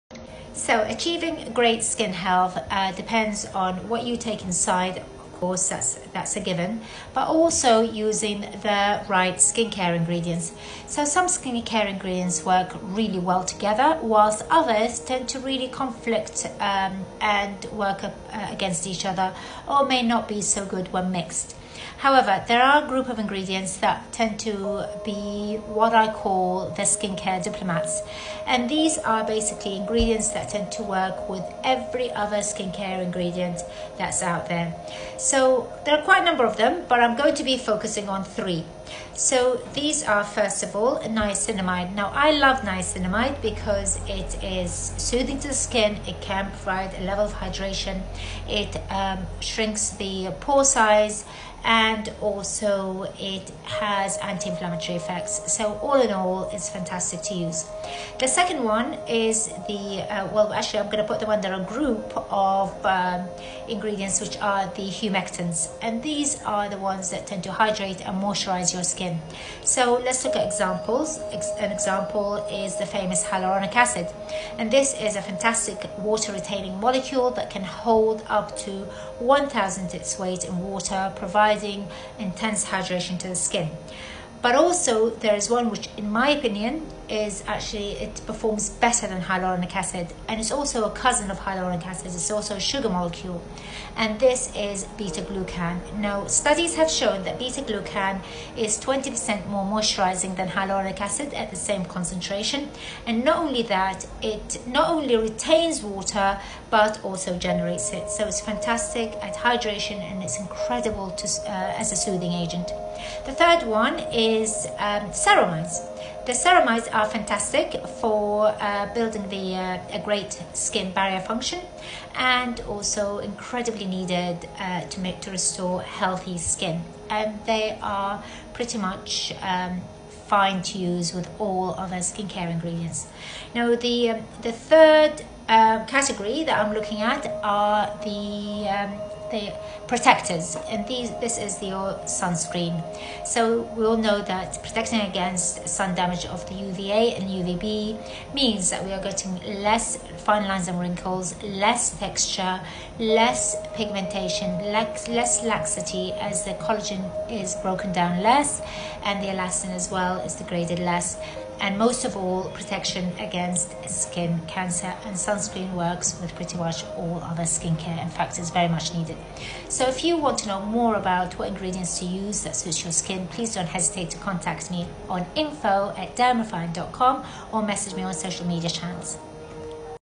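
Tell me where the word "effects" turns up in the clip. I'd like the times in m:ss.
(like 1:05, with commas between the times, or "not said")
0:54.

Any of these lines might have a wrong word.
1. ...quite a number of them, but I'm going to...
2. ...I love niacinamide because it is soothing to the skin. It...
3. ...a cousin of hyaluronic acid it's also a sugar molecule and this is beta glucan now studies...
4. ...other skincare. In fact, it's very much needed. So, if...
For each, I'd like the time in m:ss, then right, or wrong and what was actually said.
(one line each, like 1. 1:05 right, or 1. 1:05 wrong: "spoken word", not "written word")
1. 0:36 right
2. 0:42 right
3. 1:30 right
4. 2:47 right.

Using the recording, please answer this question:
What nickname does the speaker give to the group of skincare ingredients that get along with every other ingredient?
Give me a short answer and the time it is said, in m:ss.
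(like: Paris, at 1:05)
skincare diplomats, at 0:26.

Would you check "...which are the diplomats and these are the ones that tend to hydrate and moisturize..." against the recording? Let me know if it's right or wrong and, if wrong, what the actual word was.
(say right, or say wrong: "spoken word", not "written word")
wrong: "humectants", not "diplomats".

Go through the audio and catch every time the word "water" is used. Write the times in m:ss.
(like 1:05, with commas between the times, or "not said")
1:15, 1:20, 1:45.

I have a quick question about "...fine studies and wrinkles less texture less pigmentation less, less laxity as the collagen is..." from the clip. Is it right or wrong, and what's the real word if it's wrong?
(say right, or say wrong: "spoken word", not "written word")
wrong: "lines", not "studies".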